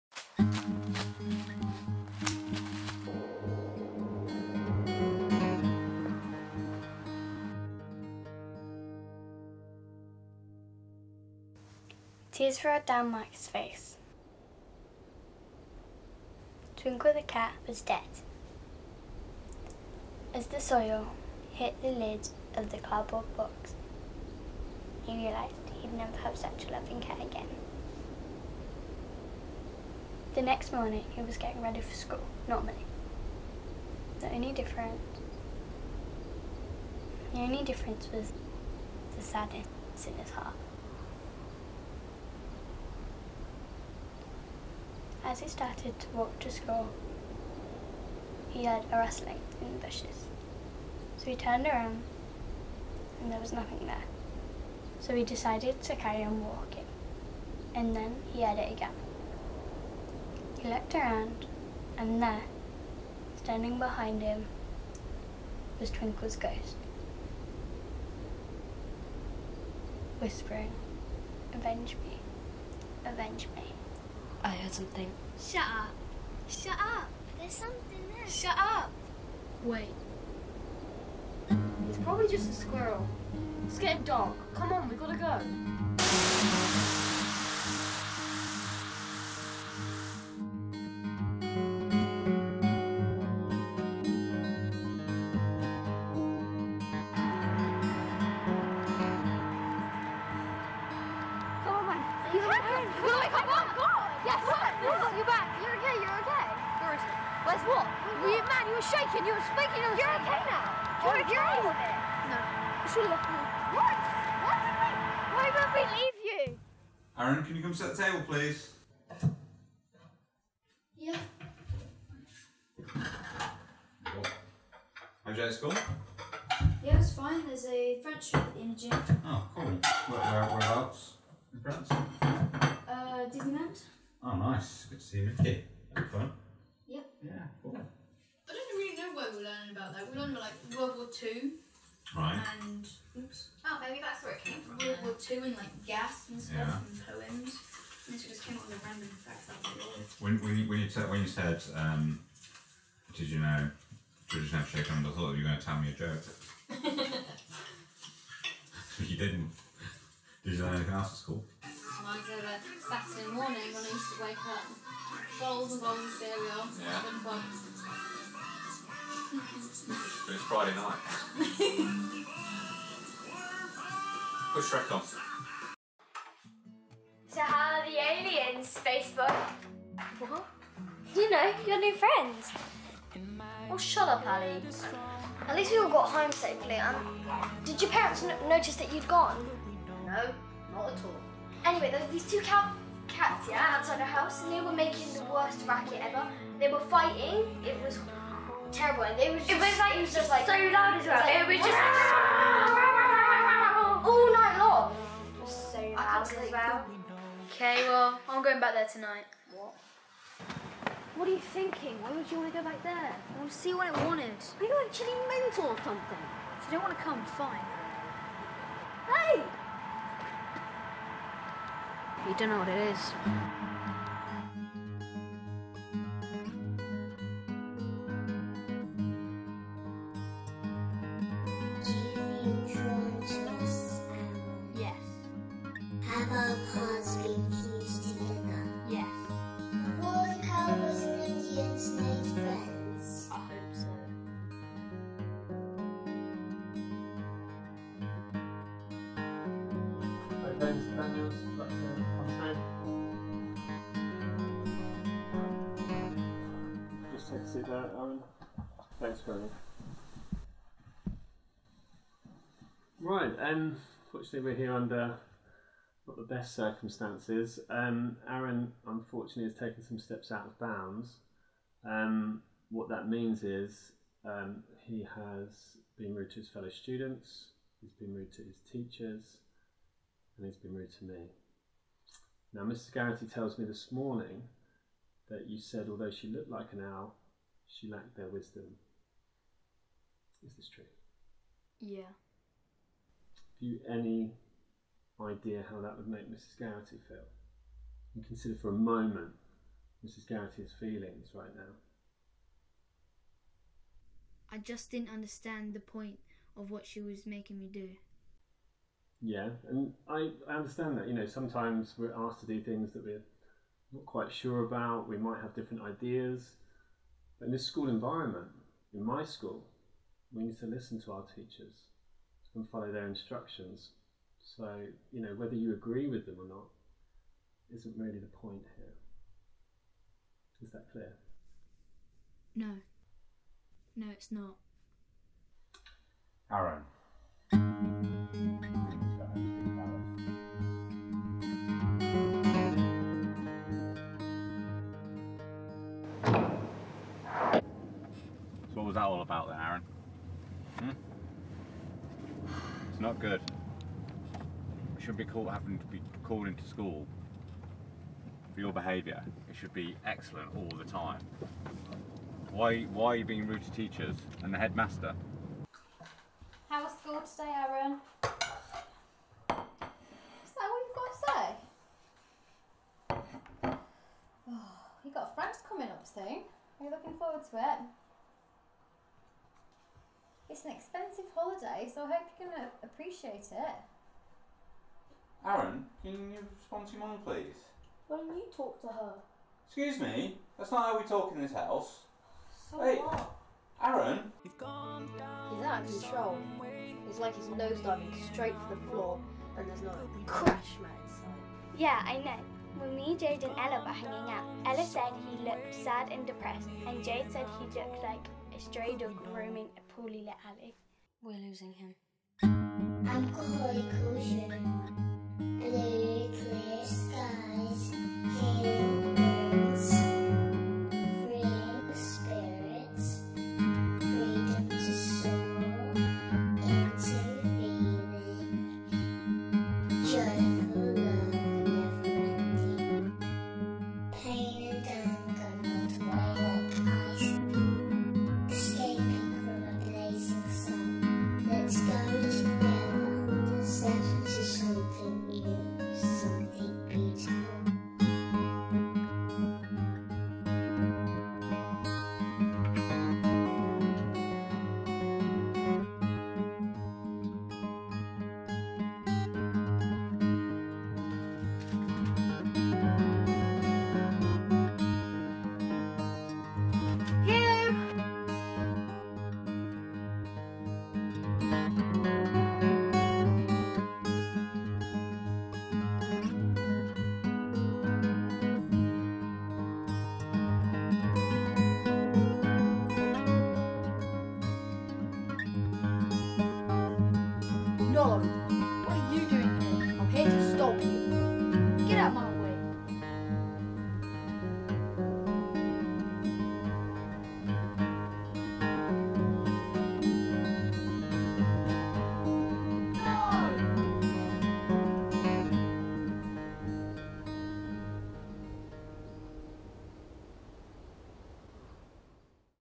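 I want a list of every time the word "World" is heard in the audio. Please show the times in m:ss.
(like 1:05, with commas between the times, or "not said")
2:20, 2:24.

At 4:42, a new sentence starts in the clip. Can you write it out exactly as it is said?
Garrity tells me this morning that you said, although she looked like an owl, she lacked their wisdom.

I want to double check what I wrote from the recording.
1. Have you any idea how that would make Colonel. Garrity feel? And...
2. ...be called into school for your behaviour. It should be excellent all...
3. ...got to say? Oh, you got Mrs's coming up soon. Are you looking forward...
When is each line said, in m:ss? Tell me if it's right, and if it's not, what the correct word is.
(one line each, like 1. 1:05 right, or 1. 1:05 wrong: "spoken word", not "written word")
1. 4:52 wrong: "Mrs", not "Colonel"
2. 5:55 right
3. 6:10 wrong: "Frank", not "Mrs".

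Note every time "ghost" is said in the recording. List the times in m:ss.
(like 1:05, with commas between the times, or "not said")
1:06.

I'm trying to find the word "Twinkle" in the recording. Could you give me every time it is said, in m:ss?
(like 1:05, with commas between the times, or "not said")
0:16, 1:05.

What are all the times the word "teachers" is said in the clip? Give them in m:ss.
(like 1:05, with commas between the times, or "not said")
4:38, 5:21, 6:03.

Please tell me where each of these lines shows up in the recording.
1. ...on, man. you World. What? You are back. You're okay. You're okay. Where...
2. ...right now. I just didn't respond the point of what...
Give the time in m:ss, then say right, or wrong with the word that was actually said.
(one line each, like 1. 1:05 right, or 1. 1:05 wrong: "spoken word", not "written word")
1. 1:41 wrong: "Yes", not "World"
2. 5:01 wrong: "understand", not "respond".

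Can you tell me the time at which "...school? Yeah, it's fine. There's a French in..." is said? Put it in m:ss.
2:05.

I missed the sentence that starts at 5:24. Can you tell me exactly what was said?
So, you know, whether you agree with them or not isn't really the point here.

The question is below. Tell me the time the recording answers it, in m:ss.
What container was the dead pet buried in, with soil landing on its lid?
0:22.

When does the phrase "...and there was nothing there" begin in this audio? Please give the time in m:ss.
0:53.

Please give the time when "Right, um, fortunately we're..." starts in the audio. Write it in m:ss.
4:22.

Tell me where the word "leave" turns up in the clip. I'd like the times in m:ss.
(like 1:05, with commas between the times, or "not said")
1:55.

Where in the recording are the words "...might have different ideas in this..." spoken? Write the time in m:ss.
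5:15.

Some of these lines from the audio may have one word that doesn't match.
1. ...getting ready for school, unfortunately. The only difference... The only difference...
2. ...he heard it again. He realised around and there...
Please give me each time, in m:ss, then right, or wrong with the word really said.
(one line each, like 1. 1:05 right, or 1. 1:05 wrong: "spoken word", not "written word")
1. 0:31 wrong: "normally", not "unfortunately"
2. 0:58 wrong: "looked", not "realised".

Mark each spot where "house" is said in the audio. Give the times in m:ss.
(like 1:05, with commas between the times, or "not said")
3:14, 6:31.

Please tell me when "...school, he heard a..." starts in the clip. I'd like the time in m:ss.
0:46.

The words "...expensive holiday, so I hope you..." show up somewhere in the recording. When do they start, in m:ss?
6:20.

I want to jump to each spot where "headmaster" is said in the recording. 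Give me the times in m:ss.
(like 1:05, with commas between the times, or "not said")
6:04.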